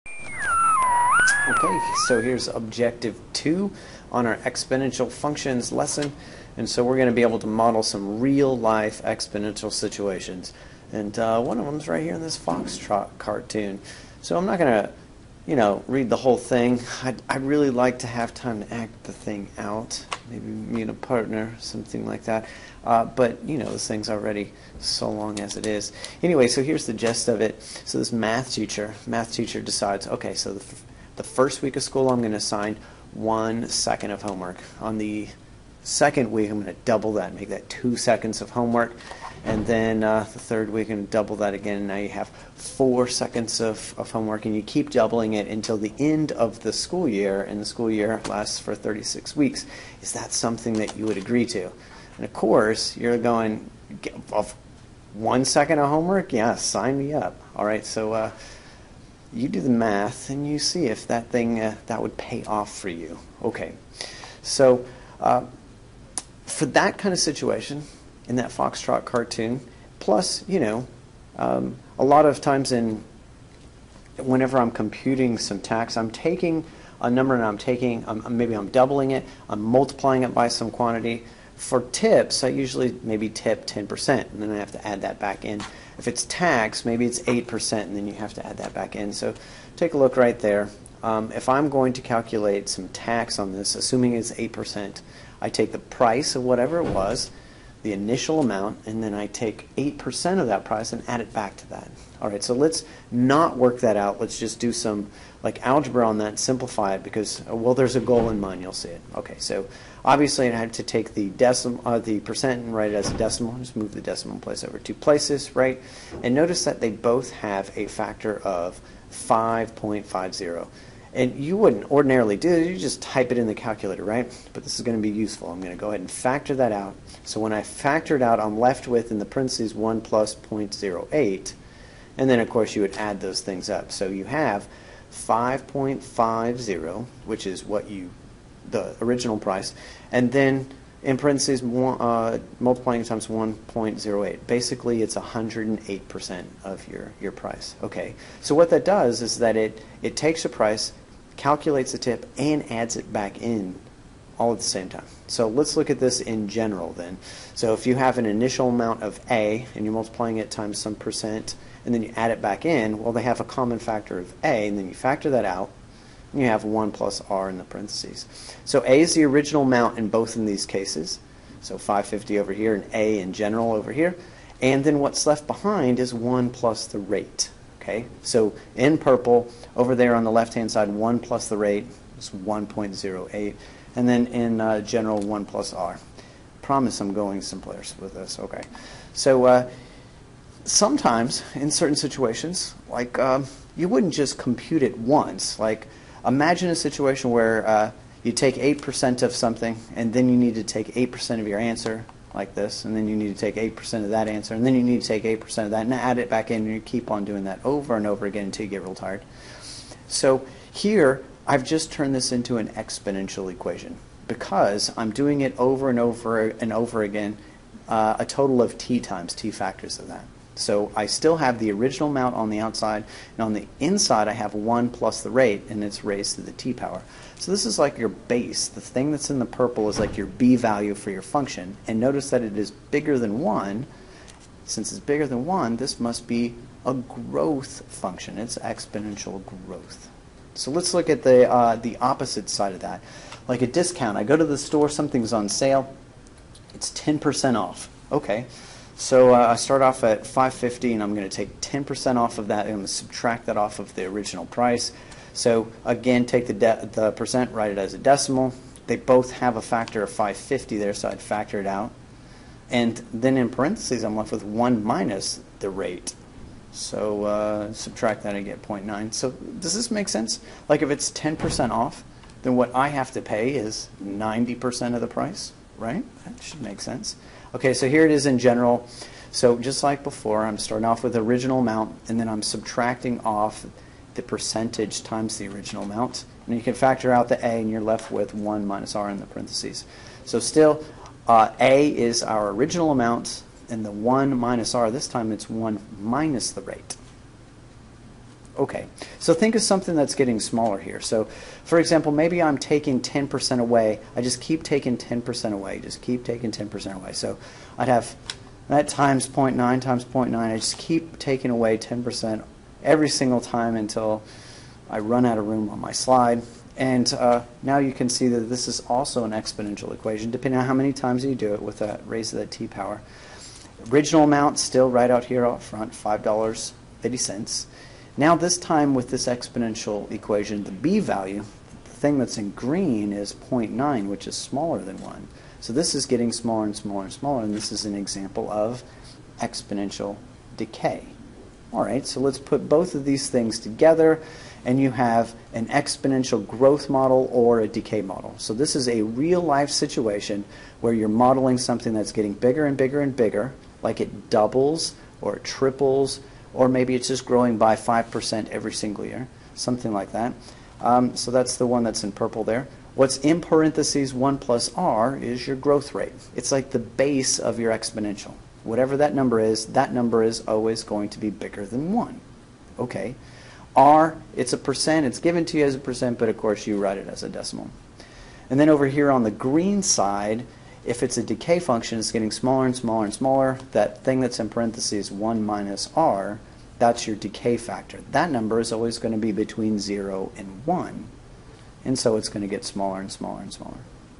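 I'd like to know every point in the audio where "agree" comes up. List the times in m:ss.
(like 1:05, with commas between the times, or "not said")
0:51.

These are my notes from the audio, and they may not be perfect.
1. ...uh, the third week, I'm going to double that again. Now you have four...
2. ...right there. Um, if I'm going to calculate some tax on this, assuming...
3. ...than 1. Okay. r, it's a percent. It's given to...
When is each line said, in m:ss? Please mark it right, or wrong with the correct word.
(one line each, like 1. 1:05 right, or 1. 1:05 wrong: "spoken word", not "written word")
1. 0:40 right
2. 1:30 right
3. 6:11 right.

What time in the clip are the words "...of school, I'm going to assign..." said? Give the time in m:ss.
0:31.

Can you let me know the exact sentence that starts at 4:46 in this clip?
And you can factor out the a, and you're left with 1 minus r in the parentheses.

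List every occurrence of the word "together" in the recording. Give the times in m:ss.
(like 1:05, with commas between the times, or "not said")
5:43.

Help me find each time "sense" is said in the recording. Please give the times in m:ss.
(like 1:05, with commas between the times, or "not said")
4:30, 4:36.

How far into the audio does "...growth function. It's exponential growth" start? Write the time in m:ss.
3:56.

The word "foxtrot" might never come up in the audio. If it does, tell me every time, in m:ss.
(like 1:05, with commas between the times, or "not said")
0:12, 1:08.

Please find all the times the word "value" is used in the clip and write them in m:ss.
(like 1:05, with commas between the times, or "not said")
3:50, 5:30.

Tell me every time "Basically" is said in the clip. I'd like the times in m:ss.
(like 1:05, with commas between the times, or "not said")
2:24.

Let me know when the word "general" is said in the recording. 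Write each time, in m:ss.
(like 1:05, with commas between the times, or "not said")
2:36, 2:53, 3:04, 4:38.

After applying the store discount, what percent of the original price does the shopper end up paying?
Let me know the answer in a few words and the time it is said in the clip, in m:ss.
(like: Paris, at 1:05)
90%, at 4:34.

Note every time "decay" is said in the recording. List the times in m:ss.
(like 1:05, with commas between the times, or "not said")
5:40, 5:47, 6:21, 6:27.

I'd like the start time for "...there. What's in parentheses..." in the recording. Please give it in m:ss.
6:02.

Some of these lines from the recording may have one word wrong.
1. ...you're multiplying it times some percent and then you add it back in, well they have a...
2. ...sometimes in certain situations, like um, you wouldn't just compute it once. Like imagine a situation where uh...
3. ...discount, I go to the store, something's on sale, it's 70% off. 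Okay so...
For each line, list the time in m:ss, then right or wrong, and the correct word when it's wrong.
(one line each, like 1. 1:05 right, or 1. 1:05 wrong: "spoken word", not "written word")
1. 2:39 right
2. 3:10 right
3. 4:03 wrong: "10", not "70".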